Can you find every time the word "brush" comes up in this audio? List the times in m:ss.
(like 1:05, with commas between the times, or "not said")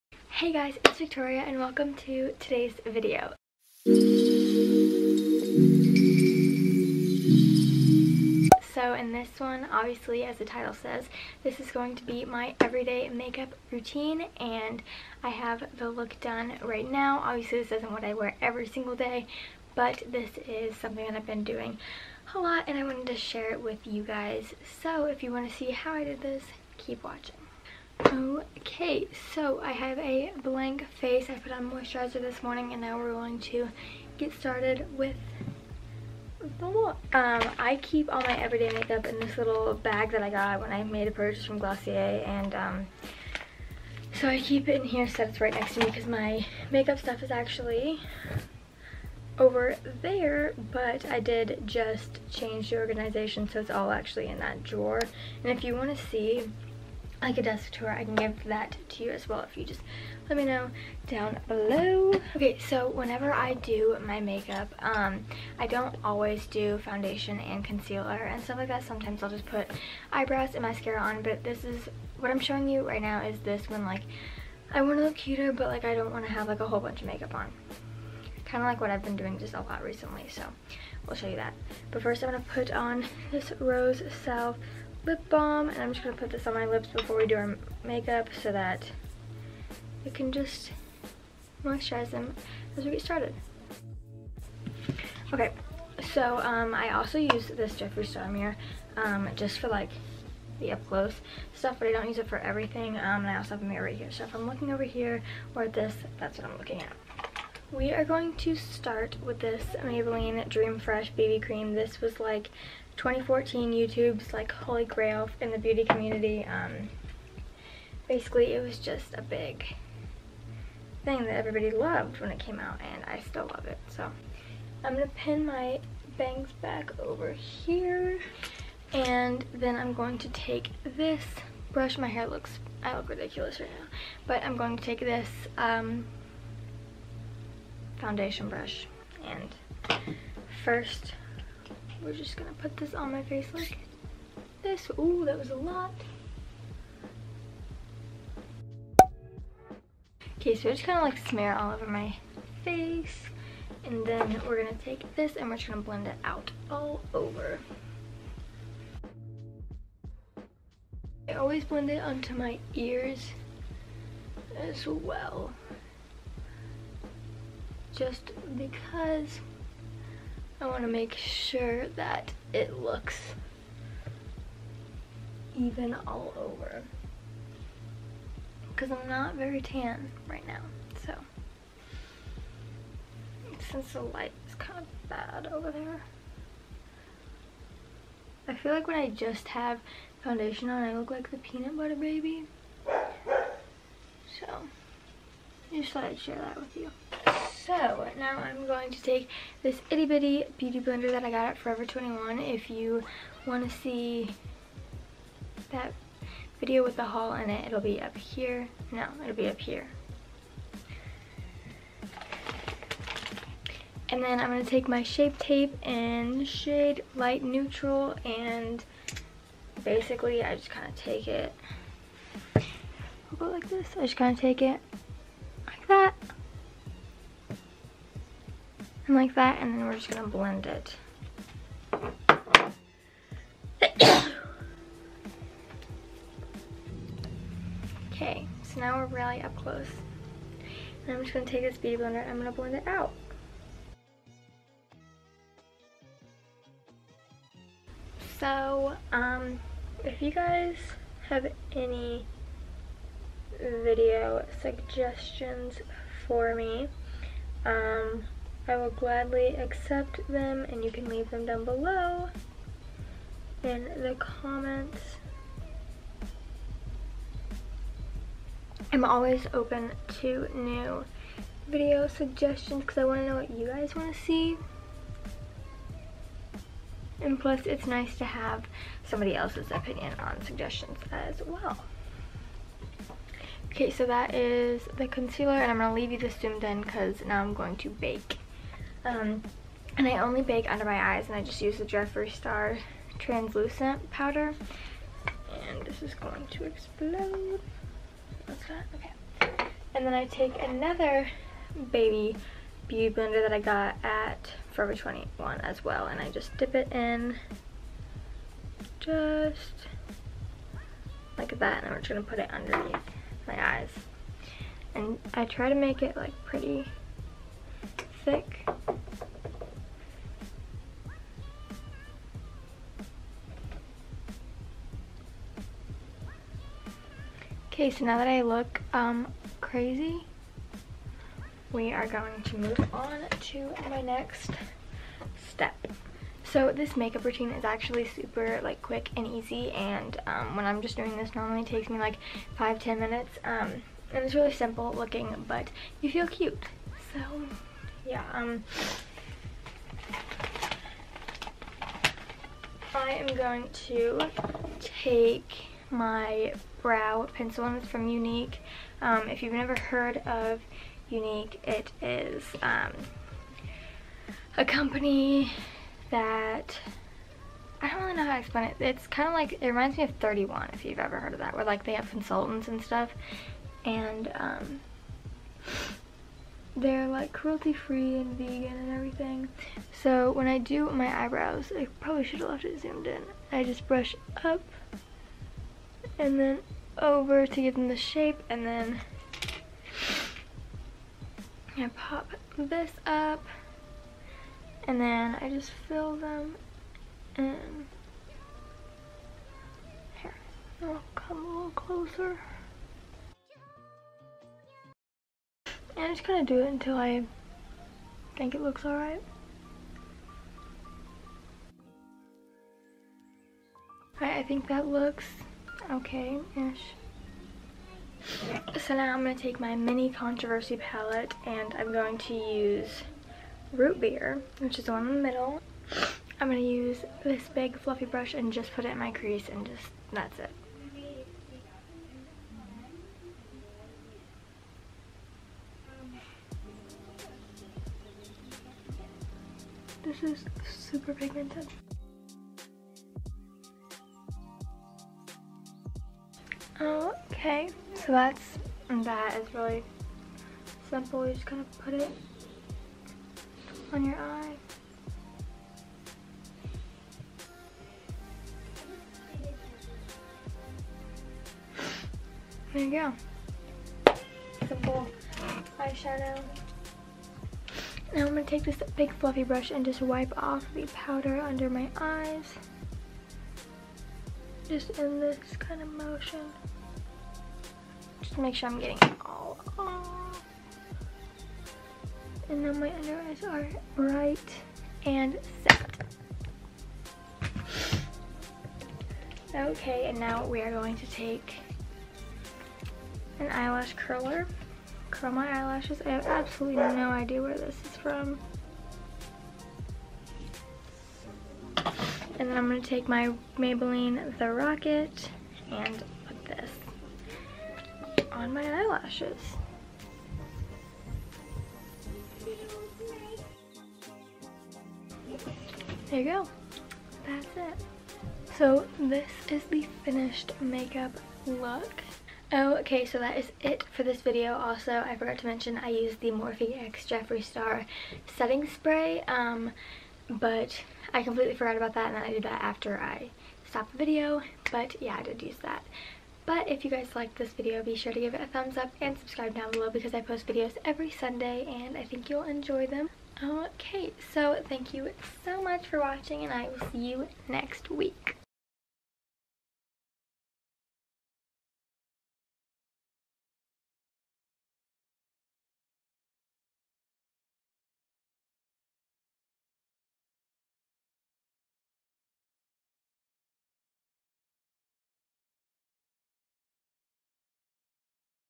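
2:11, 2:18, 6:23, 7:08, 7:49.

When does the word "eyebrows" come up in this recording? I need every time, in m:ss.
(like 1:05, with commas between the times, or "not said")
1:10, 6:21.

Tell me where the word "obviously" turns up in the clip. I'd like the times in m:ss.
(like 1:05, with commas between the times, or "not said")
0:09, 0:17.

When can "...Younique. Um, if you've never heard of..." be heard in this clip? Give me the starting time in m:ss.
5:58.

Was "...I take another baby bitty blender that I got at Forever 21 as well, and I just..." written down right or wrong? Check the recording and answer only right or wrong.
wrong.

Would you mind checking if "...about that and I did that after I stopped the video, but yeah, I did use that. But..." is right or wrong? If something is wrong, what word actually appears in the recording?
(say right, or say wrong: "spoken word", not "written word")
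right.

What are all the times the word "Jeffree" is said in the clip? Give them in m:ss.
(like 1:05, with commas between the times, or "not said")
1:37, 4:51, 8:47.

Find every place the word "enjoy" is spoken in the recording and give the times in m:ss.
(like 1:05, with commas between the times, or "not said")
9:02.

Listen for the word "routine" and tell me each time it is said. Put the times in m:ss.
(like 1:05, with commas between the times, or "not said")
0:13, 5:37.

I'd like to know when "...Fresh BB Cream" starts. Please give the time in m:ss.
1:50.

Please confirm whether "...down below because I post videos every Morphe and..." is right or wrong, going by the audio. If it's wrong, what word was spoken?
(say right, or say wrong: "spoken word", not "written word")
wrong: "Sunday", not "Morphe".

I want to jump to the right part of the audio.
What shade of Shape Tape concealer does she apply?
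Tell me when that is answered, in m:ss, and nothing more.
3:37.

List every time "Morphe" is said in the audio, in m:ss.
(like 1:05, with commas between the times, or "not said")
8:46.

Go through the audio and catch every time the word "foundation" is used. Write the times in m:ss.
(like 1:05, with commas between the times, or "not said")
1:06, 2:18, 3:10.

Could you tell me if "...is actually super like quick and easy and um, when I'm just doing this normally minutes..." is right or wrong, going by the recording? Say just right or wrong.
wrong.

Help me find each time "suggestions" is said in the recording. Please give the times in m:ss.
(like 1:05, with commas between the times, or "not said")
4:14, 4:32, 4:40.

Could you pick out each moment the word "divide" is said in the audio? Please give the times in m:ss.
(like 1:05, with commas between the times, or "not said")
not said.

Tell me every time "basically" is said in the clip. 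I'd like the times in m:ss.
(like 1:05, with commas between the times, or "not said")
1:58, 3:39.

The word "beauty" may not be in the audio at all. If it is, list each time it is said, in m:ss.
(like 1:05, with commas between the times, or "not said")
1:55, 3:20, 4:01, 5:02.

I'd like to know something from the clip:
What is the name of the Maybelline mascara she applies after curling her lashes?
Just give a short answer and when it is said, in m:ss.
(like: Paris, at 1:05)
The Rocket, at 8:24.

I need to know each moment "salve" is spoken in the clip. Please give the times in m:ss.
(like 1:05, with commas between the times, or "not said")
1:24.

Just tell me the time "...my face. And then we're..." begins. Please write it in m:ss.
2:31.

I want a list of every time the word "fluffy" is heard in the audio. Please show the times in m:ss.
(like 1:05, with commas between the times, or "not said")
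7:07, 7:49.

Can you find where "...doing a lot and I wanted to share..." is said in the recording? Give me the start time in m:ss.
0:21.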